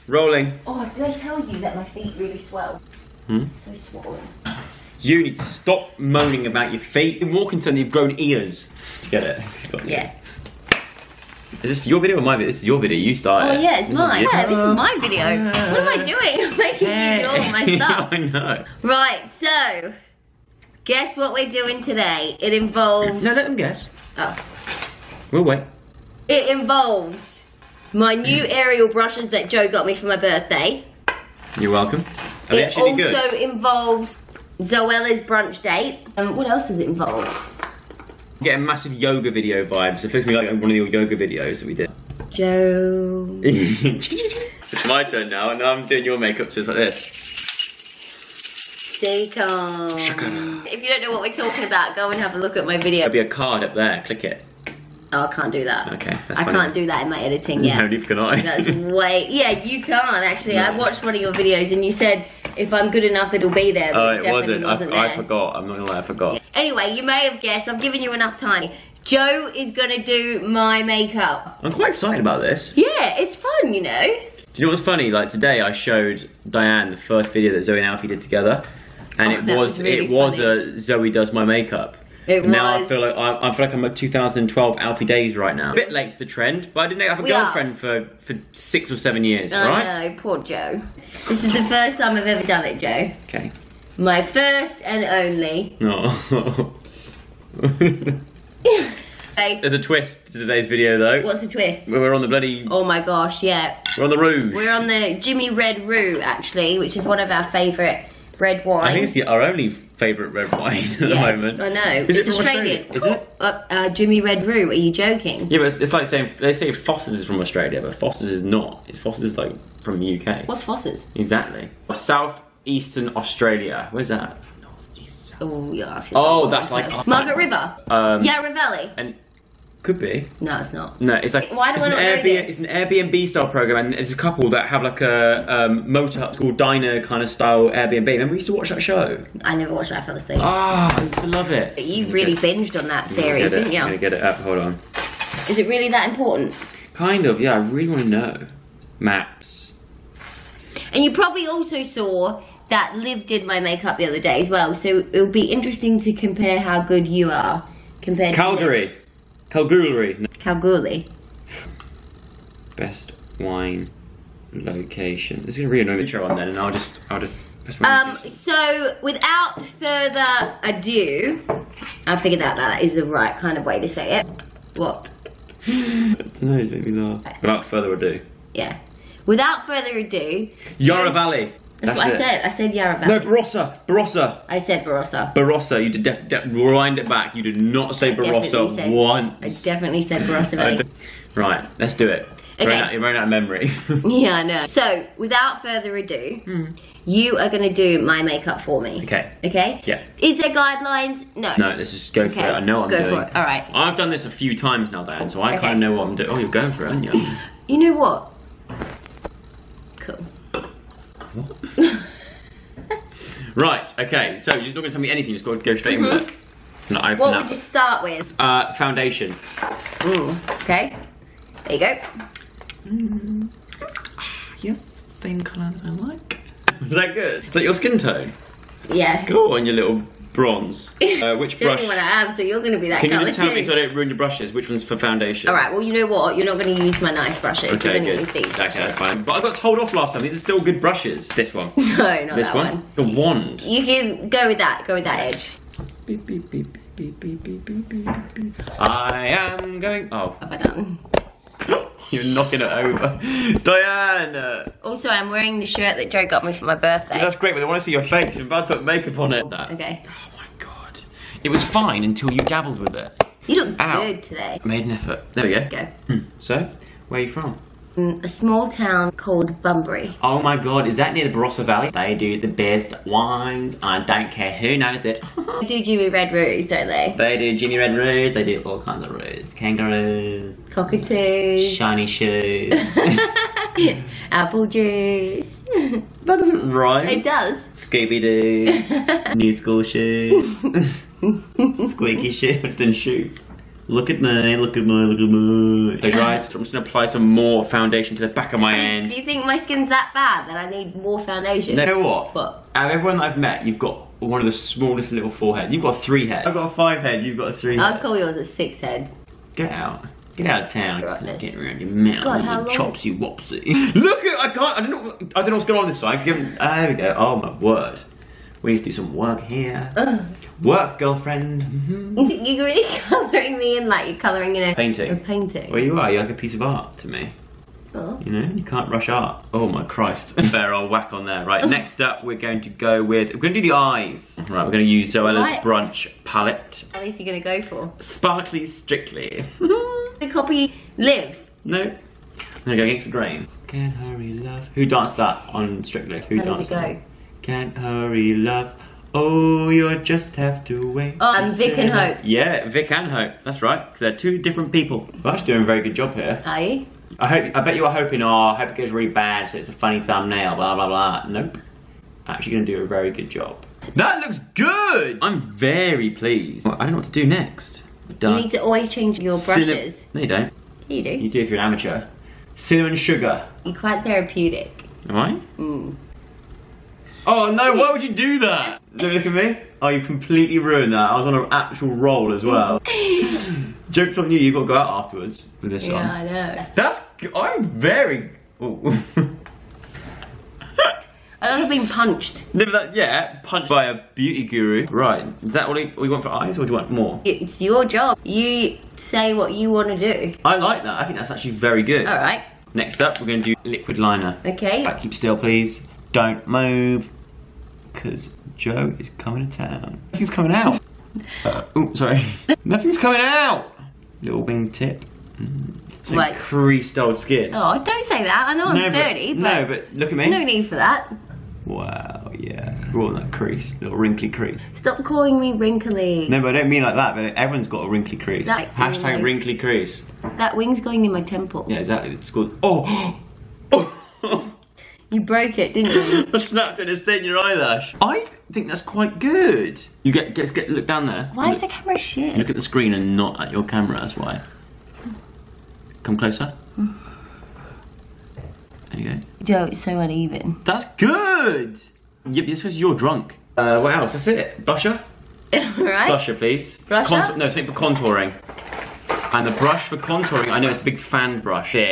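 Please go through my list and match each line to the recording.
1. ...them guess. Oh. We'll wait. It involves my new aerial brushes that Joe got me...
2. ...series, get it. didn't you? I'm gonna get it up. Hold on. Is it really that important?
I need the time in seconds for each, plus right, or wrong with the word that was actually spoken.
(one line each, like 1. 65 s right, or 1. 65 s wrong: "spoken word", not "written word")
1. 23 s right
2. 143 s right.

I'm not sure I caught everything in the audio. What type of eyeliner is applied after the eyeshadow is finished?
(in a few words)
Liquid liner.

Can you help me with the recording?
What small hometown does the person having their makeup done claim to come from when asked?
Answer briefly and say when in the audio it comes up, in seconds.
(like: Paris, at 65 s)
Bunbury, at 269 s.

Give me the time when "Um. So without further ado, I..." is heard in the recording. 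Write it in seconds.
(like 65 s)
167 s.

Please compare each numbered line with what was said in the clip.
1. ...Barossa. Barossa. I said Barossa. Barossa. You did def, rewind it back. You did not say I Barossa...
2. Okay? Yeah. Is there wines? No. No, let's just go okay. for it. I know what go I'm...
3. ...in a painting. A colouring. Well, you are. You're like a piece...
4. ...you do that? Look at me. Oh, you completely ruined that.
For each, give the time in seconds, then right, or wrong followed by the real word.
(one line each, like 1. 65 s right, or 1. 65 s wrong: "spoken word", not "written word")
1. 183 s right
2. 199 s wrong: "guidelines", not "wines"
3. 324 s wrong: "painting", not "colouring"
4. 378 s right.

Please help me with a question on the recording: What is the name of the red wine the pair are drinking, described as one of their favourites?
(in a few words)
Jimmy Red Roo.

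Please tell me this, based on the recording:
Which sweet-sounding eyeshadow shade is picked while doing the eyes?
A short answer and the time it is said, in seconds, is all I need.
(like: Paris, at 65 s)
Cinnamon sugar, at 372 s.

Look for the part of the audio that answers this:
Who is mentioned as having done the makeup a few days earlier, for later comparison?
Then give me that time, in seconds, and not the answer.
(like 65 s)
152 s.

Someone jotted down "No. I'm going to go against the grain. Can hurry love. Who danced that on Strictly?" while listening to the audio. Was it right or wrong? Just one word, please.
right.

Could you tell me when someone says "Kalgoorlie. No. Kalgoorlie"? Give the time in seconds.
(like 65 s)
159 s.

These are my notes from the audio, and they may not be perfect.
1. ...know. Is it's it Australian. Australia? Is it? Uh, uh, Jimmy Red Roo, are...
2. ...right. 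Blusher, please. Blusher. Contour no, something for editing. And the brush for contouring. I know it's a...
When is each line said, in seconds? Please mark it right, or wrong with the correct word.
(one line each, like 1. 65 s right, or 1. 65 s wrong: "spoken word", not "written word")
1. 111 s right
2. 455 s wrong: "contouring", not "editing".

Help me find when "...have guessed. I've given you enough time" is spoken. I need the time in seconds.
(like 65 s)
67 s.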